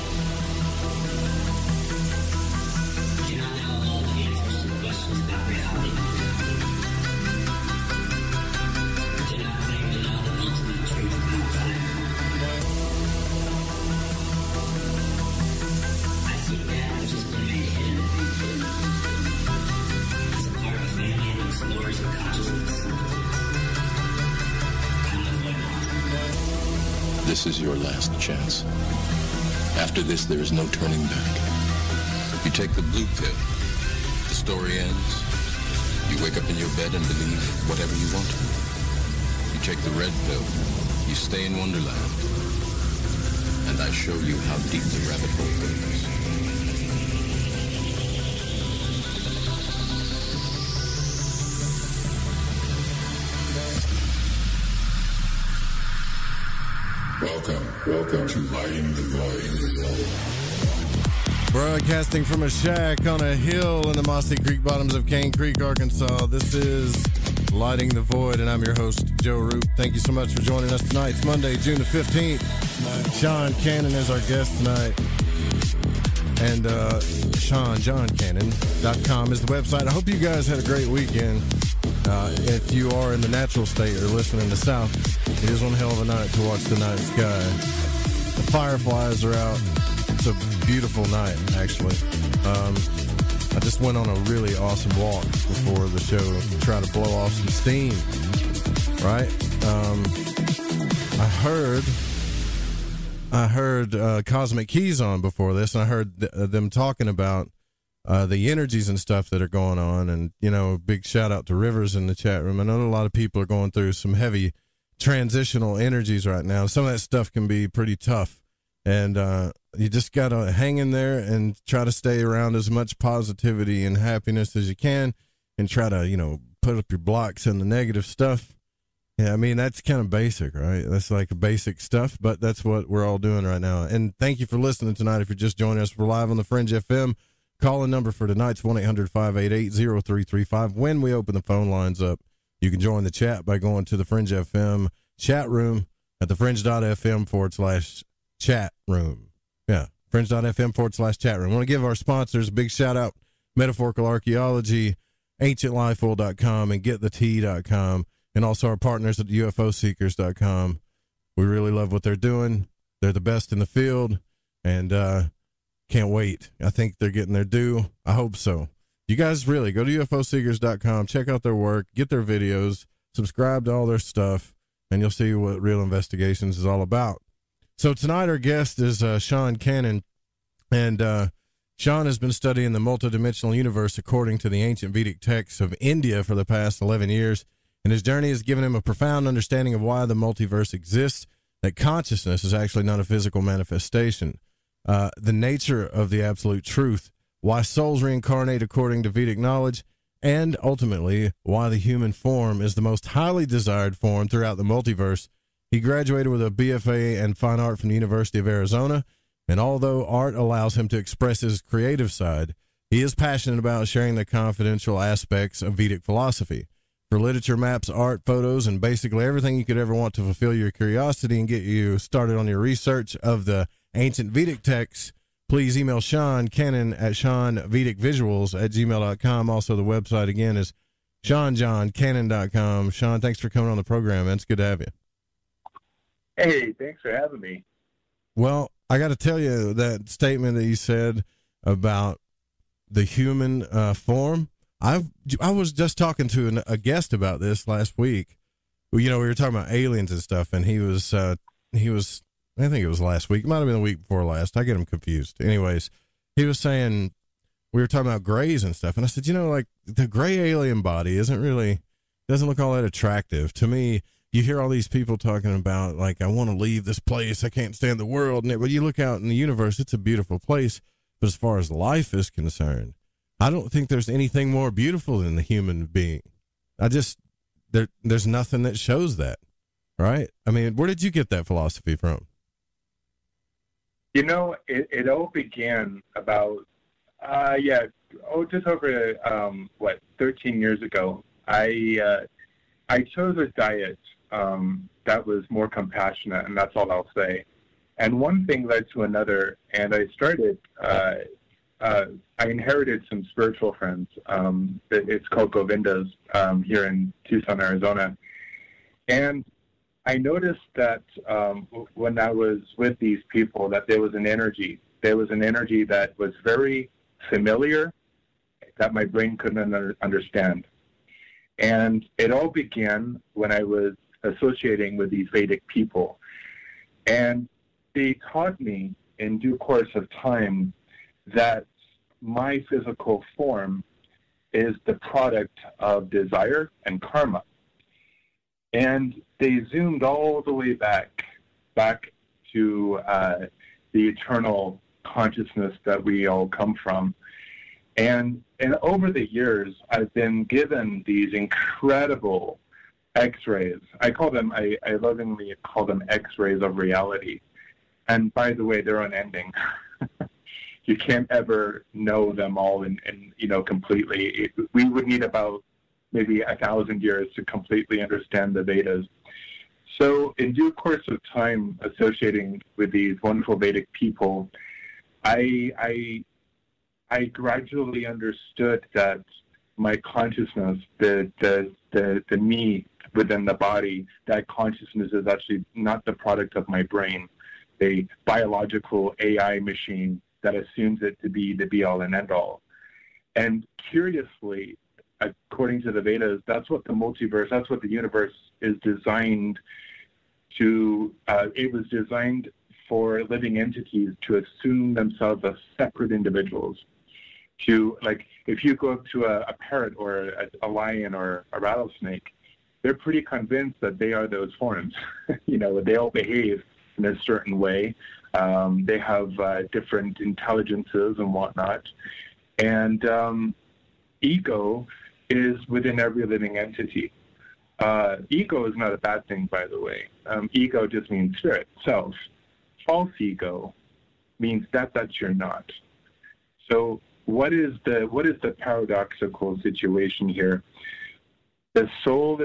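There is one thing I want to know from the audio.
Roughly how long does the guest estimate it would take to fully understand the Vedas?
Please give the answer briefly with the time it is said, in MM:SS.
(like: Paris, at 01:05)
1000 years, at 06:06.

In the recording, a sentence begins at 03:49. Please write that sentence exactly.
Also, the website again is SeanJohnCannon.com.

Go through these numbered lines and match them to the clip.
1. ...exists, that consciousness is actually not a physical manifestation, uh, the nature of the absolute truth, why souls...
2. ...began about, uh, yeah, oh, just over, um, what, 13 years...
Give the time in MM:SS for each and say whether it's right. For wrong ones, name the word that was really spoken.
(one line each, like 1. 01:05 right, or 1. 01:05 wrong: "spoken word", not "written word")
1. 03:10 right
2. 04:45 right.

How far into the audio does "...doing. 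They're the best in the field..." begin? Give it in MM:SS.
02:42.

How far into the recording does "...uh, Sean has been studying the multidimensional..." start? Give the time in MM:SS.
03:00.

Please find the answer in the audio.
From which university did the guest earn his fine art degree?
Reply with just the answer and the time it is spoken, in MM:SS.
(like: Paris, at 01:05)
University of Arizona, at 03:27.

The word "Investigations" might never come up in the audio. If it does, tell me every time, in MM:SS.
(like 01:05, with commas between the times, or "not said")
02:55.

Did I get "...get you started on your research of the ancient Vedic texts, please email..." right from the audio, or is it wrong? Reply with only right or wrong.
right.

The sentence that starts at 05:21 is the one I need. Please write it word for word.
And it all began when I was associating with these Vedic people.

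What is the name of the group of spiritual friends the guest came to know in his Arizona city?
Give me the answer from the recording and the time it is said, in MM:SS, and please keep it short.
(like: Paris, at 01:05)
Govindas, at 05:05.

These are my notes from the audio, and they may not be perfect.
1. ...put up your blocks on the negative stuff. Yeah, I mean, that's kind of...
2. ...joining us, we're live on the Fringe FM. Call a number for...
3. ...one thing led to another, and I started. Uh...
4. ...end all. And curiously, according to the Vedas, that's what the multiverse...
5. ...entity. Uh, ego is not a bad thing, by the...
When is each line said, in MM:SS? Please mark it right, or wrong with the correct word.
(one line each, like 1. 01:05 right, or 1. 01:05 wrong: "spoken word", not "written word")
1. 02:06 right
2. 02:15 right
3. 04:58 right
4. 06:32 right
5. 07:06 right.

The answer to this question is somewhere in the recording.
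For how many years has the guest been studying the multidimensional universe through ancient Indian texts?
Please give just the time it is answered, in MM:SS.
03:06.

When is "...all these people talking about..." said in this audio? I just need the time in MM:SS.
04:24.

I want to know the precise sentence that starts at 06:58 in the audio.
Um, they have uh, different intelligences and whatnot.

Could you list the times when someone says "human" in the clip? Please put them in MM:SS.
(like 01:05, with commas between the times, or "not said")
03:21, 04:03, 04:35.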